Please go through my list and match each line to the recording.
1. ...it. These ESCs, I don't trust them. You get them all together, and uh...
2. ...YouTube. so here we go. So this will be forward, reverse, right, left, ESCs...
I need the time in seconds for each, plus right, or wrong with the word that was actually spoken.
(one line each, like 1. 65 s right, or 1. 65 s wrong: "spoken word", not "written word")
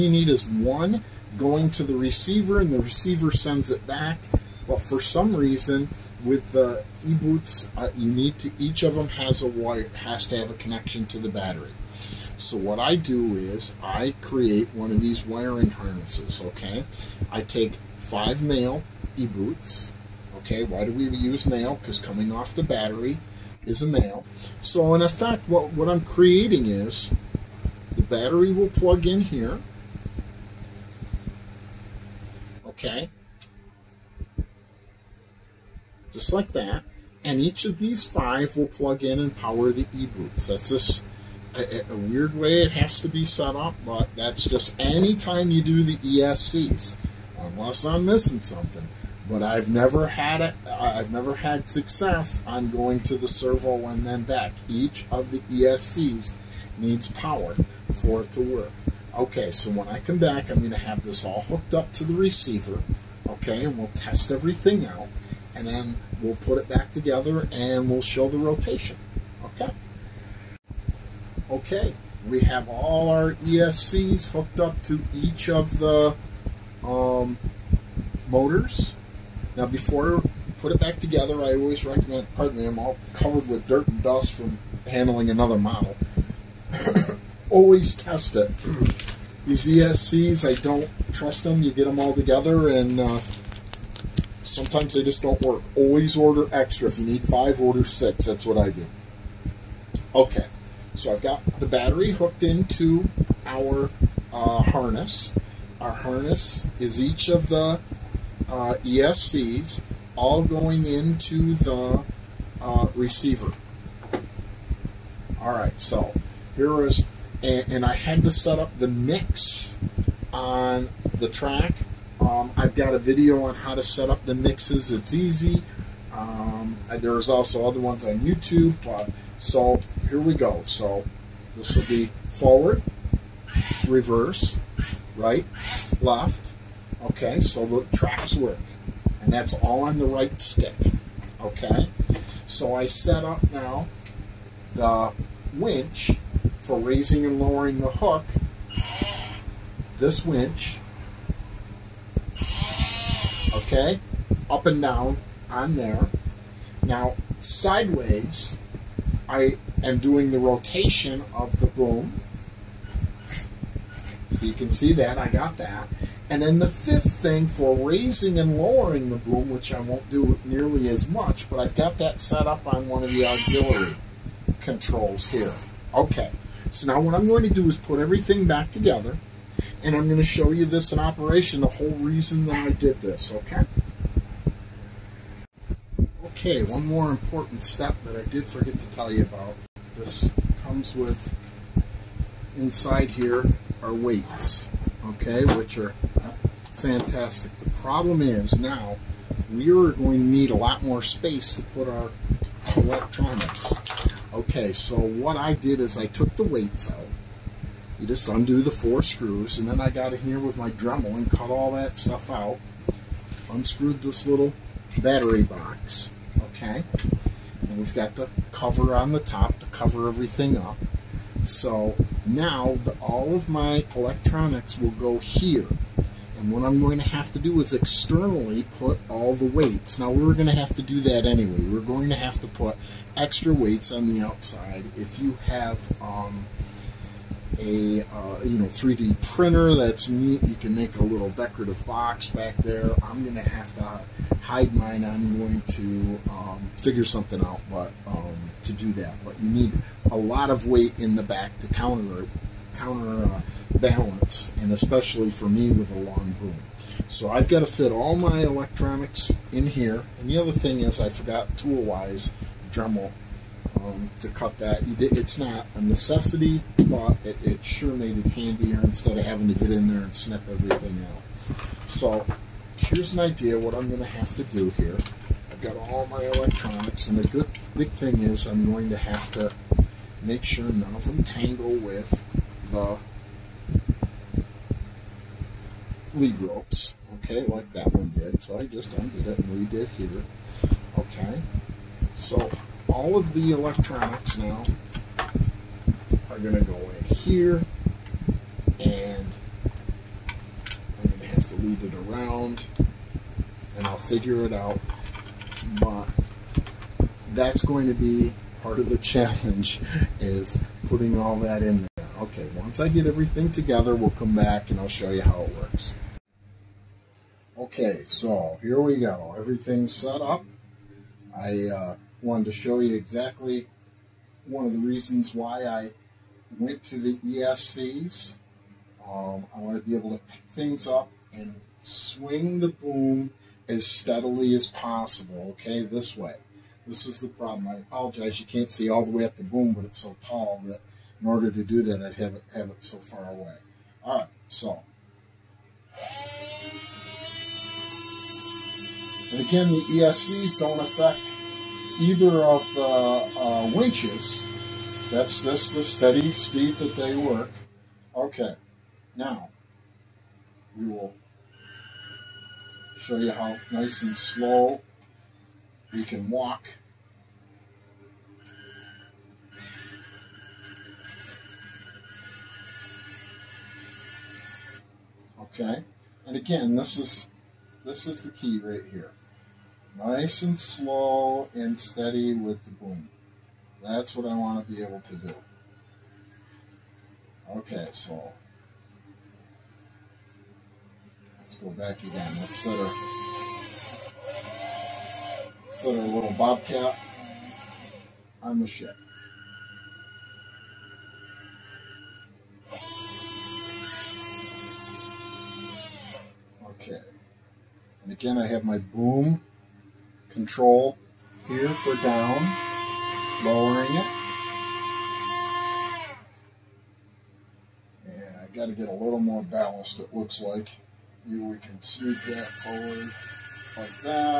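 1. 88 s right
2. 128 s wrong: "Okay", not "ESCs".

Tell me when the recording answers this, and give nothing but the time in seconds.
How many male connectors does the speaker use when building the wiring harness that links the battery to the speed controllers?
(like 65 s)
17 s.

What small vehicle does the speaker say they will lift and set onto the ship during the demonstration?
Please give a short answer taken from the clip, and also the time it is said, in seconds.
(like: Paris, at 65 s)
Bobcat, at 396 s.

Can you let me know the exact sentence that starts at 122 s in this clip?
Um, I've got a video on how to set up the mixes.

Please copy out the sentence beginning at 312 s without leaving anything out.
Once I get everything together, we'll come back and I'll show you how it works.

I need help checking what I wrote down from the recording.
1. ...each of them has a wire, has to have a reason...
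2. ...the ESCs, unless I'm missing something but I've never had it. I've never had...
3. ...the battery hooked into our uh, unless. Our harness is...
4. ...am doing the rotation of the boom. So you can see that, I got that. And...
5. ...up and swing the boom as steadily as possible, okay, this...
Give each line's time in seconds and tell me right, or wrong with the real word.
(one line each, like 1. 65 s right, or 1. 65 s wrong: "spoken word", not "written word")
1. 8 s wrong: "connection", not "reason"
2. 45 s right
3. 101 s wrong: "harness", not "unless"
4. 159 s right
5. 330 s right.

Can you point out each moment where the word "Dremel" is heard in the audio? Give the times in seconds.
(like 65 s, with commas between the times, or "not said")
210 s, 262 s.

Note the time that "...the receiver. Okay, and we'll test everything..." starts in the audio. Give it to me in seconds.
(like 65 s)
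62 s.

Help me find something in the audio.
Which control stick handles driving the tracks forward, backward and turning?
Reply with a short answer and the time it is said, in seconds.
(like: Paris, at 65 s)
The right stick, at 140 s.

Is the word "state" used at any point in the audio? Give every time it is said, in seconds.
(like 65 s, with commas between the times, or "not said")
not said.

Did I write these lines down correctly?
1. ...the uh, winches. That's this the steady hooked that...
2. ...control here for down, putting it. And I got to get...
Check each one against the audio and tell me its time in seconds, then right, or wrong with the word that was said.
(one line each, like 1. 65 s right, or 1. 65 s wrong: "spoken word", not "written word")
1. 352 s wrong: "speed", not "hooked"
2. 410 s wrong: "lowering", not "putting".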